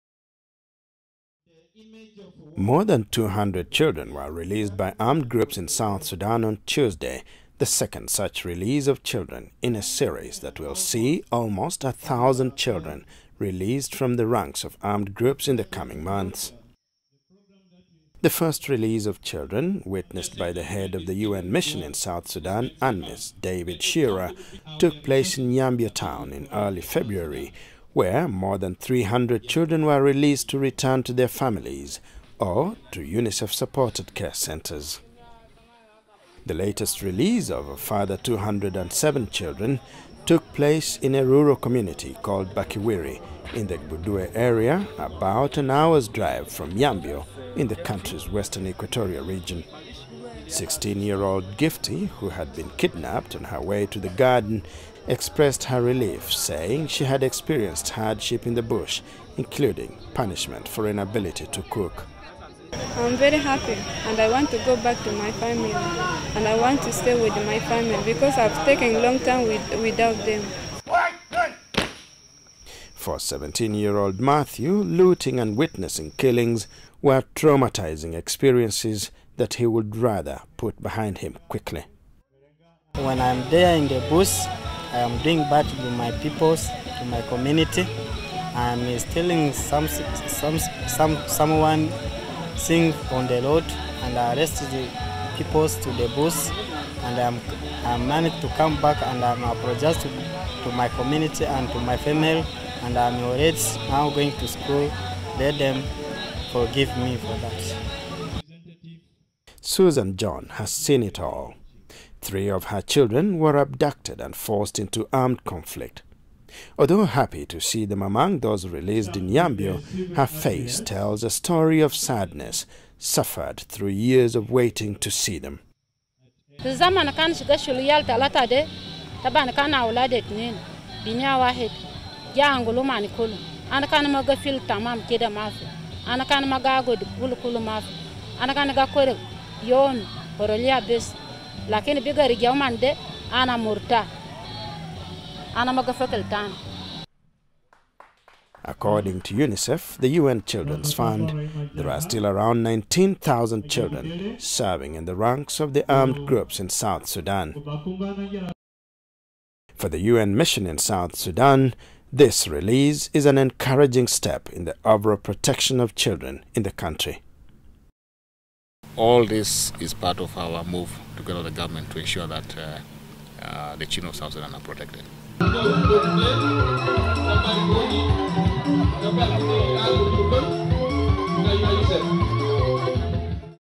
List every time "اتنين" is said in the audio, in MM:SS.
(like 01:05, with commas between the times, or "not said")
02:10.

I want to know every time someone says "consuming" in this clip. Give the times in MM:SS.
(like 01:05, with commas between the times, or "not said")
not said.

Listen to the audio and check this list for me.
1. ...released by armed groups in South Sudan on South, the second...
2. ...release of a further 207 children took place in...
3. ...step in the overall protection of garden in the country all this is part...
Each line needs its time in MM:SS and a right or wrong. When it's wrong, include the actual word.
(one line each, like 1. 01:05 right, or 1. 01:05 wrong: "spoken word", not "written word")
1. 00:04 wrong: "Tuesday", not "South"
2. 00:37 right
3. 02:44 wrong: "children", not "garden".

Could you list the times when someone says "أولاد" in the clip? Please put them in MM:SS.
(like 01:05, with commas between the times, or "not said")
02:09.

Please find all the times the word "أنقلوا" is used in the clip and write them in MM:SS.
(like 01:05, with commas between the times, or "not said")
02:12.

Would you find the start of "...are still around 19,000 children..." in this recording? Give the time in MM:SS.
02:31.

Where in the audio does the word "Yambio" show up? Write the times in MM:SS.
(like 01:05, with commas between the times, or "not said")
00:25, 00:46, 01:59.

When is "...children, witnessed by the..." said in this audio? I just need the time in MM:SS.
00:19.